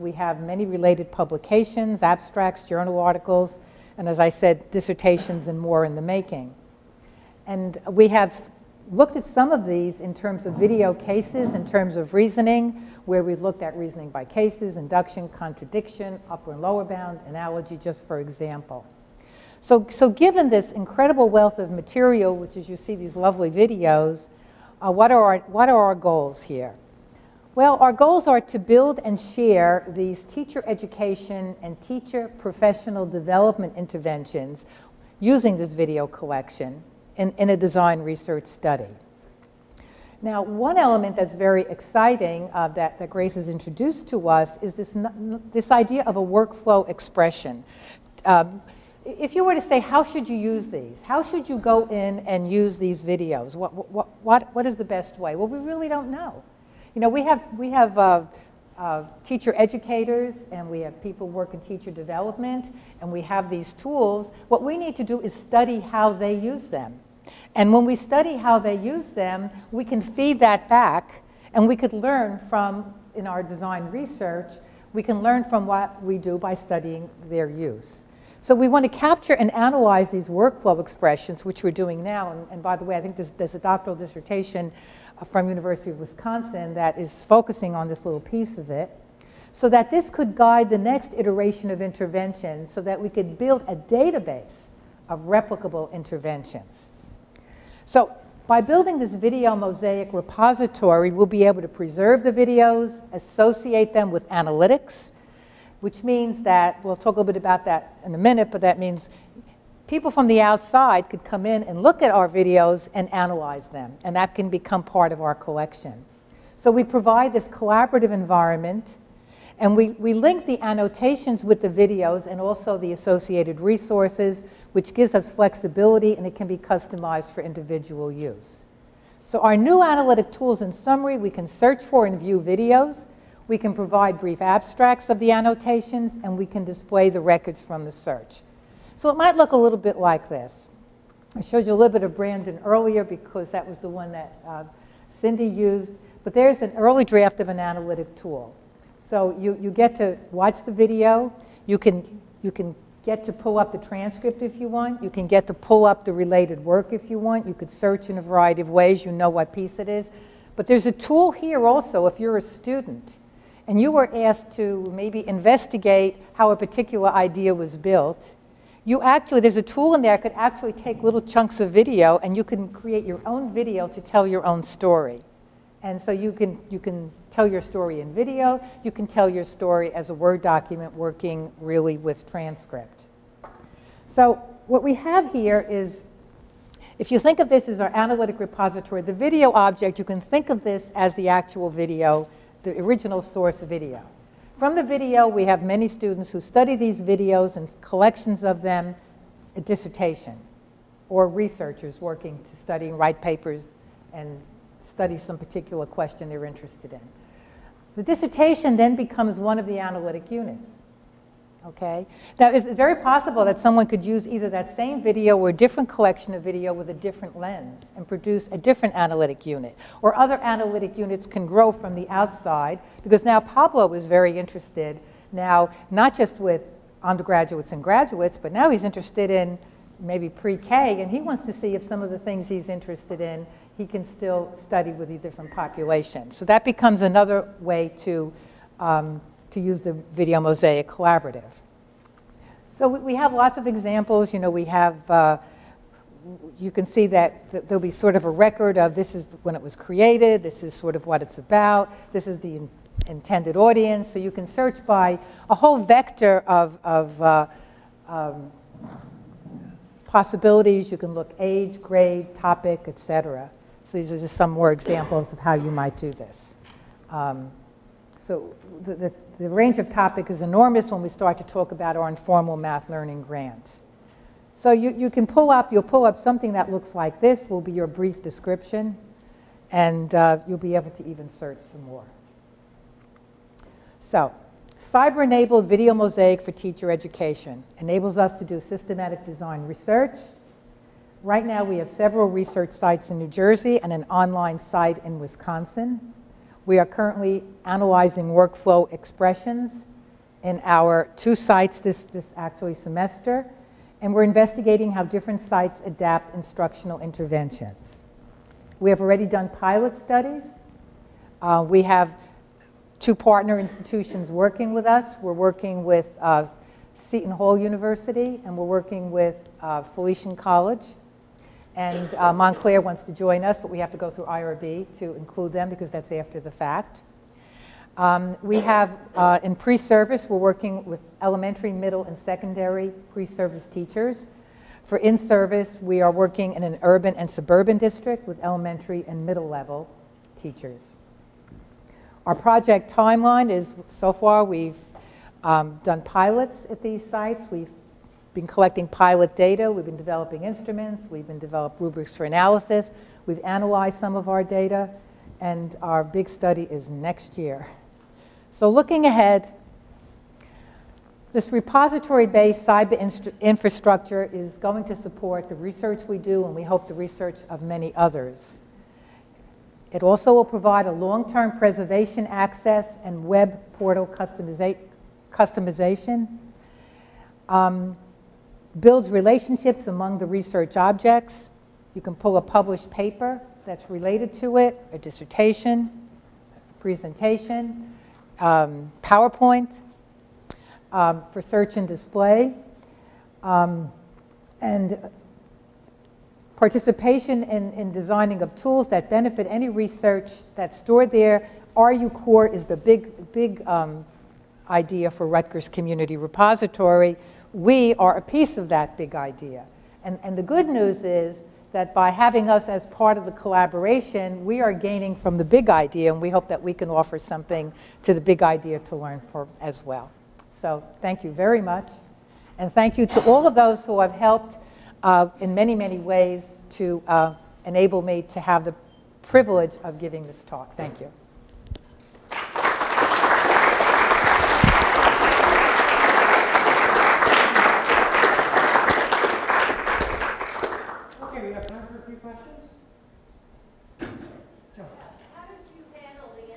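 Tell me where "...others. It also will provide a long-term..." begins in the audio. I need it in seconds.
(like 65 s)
367 s.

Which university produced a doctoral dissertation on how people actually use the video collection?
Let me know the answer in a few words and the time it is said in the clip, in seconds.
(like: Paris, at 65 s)
University of Wisconsin, at 85 s.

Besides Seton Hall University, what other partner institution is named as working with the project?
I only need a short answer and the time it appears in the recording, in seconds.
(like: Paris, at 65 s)
Felician College, at 319 s.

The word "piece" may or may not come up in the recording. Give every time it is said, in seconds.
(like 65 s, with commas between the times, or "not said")
88 s, 159 s, 408 s.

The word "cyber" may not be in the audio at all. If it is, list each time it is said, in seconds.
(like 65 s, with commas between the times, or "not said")
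284 s, 362 s.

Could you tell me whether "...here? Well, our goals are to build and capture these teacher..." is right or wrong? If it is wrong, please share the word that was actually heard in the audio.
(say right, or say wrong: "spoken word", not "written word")
wrong: "share", not "capture".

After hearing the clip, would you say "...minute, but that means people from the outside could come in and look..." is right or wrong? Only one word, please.
right.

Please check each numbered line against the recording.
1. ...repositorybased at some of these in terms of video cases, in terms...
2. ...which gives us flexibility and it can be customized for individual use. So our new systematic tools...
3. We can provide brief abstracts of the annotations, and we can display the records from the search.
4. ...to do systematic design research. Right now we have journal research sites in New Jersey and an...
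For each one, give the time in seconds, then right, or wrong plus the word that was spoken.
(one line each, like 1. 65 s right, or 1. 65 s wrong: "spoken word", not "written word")
1. 8 s wrong: "looked", not "repositorybased"
2. 124 s wrong: "analytic", not "systematic"
3. 133 s right
4. 288 s wrong: "several", not "journal".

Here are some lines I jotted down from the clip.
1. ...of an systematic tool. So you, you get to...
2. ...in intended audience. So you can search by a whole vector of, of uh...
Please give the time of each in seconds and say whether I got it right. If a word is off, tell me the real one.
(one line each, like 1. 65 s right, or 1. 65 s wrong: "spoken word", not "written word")
1. 147 s wrong: "analytic", not "systematic"
2. 252 s right.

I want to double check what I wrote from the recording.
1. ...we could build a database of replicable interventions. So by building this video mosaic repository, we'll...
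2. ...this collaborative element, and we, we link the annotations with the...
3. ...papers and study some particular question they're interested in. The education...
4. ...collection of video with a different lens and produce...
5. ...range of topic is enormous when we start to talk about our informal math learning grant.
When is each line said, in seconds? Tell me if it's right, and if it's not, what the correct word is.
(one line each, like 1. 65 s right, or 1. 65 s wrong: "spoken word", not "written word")
1. 92 s right
2. 117 s wrong: "environment", not "element"
3. 203 s wrong: "dissertation", not "education"
4. 215 s right
5. 269 s right.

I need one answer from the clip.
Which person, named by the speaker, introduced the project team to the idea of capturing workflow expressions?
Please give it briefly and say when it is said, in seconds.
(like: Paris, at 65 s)
Grace, at 43 s.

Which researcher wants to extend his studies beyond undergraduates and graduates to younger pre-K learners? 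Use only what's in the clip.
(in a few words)
Pablo.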